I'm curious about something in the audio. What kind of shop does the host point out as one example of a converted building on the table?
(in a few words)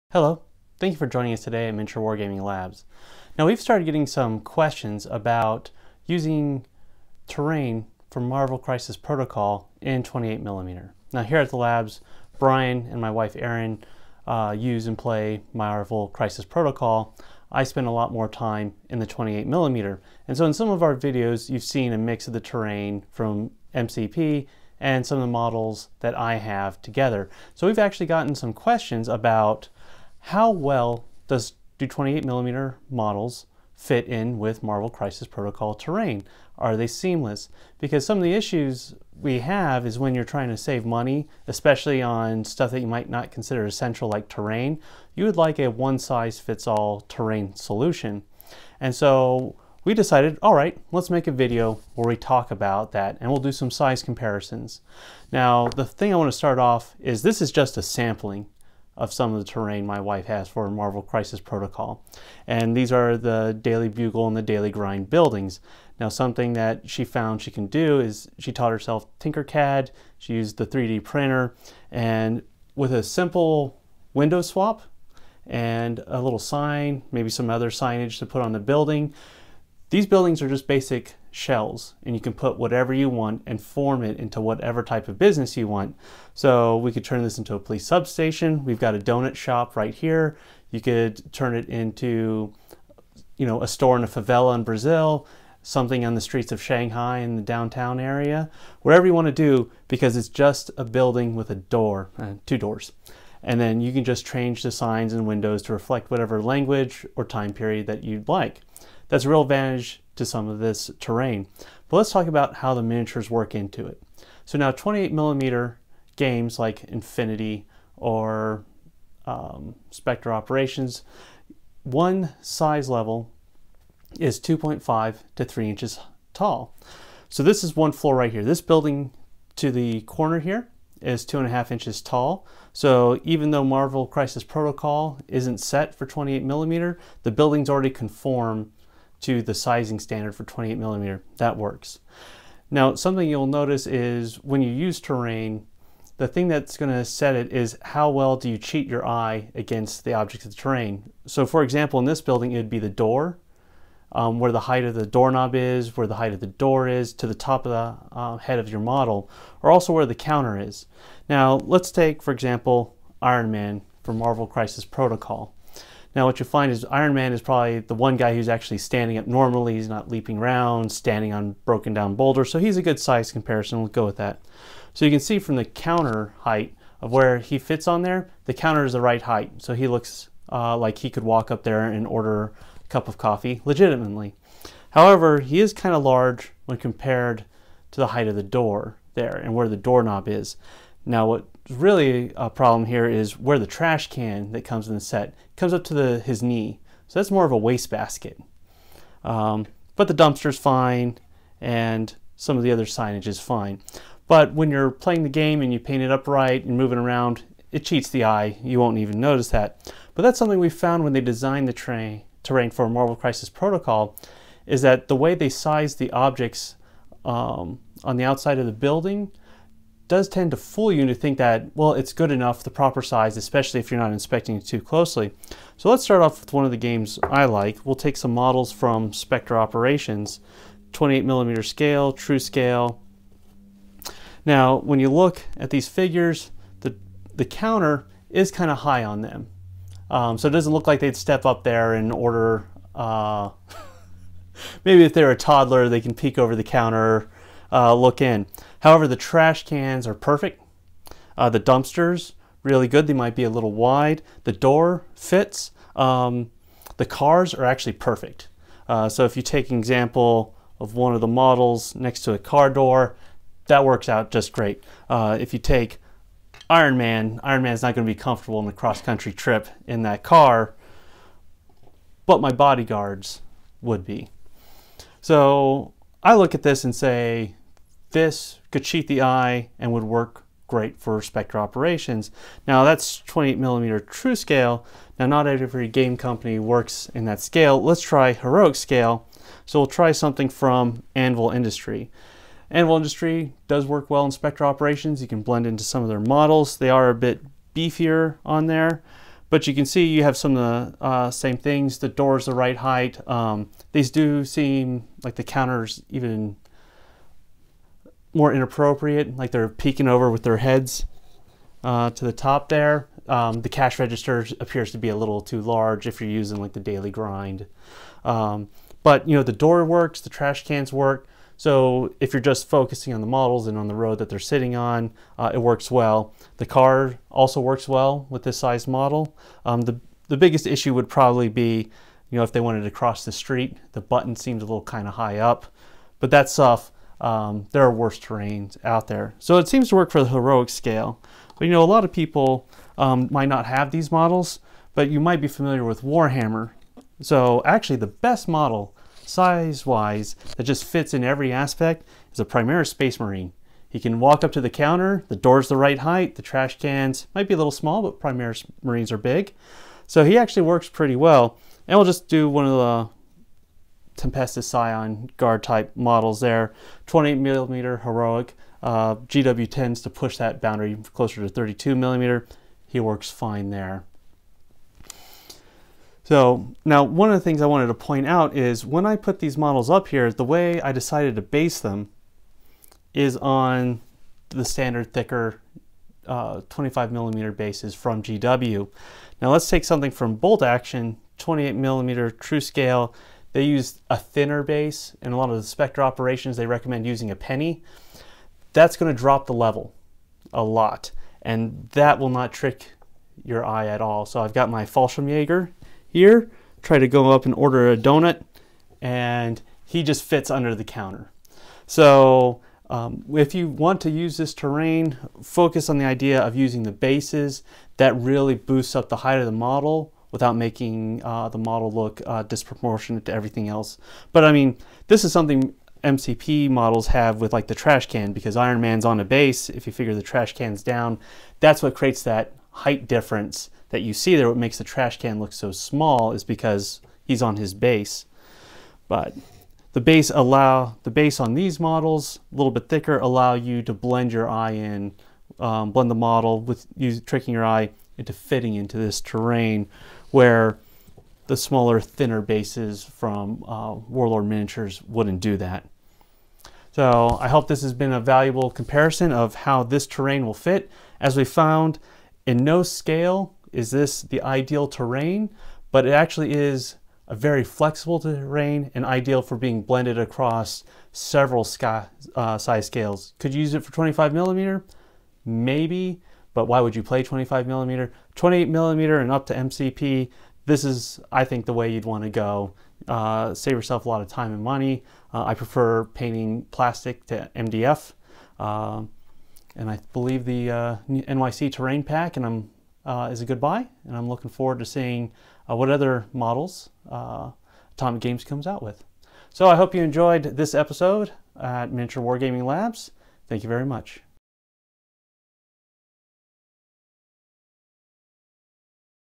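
donut shop.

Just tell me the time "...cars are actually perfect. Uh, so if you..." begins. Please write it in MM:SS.
04:17.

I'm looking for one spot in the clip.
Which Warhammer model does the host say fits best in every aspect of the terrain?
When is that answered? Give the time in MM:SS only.
05:52.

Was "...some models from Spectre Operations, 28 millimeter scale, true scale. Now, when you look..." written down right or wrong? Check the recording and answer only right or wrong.
right.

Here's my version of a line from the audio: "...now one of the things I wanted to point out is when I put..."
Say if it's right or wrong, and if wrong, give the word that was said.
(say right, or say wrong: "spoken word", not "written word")
right.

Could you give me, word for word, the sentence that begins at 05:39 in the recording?
So it seems to work for the heroic scale.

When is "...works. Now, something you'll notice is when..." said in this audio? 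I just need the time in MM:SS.
02:21.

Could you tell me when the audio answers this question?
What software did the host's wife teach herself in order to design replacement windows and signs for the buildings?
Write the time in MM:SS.
01:09.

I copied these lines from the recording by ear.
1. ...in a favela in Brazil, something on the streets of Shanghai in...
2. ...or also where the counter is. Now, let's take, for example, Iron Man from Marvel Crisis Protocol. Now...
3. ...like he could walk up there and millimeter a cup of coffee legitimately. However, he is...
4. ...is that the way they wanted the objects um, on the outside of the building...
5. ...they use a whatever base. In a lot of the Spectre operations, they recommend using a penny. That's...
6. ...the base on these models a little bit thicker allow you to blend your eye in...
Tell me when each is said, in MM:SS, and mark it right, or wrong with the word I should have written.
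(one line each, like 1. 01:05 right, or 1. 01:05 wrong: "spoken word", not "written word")
1. 01:33 right
2. 02:39 right
3. 03:00 wrong: "order", not "millimeter"
4. 03:34 wrong: "sized", not "wanted"
5. 06:33 wrong: "thinner", not "whatever"
6. 07:21 right.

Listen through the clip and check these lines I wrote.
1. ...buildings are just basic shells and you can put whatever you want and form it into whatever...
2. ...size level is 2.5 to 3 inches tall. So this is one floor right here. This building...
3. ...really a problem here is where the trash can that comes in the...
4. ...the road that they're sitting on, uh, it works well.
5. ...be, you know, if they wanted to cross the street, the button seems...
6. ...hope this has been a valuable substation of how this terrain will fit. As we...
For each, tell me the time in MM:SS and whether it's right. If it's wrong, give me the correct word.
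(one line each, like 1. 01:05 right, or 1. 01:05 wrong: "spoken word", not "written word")
1. 01:20 right
2. 02:02 right
3. 03:11 right
4. 05:23 right
5. 05:31 right
6. 07:37 wrong: "comparison", not "substation".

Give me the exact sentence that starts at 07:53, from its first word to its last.
Could you use it for 25 millimeter?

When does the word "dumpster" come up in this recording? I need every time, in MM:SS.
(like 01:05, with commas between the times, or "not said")
03:20, 04:11.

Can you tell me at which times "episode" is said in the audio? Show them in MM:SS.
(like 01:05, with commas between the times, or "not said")
08:20.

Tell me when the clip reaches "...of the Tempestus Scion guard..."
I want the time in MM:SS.
06:02.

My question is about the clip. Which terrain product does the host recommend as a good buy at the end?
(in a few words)
NYC Terrain Pack.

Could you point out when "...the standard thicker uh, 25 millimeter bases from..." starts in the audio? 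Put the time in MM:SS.
06:24.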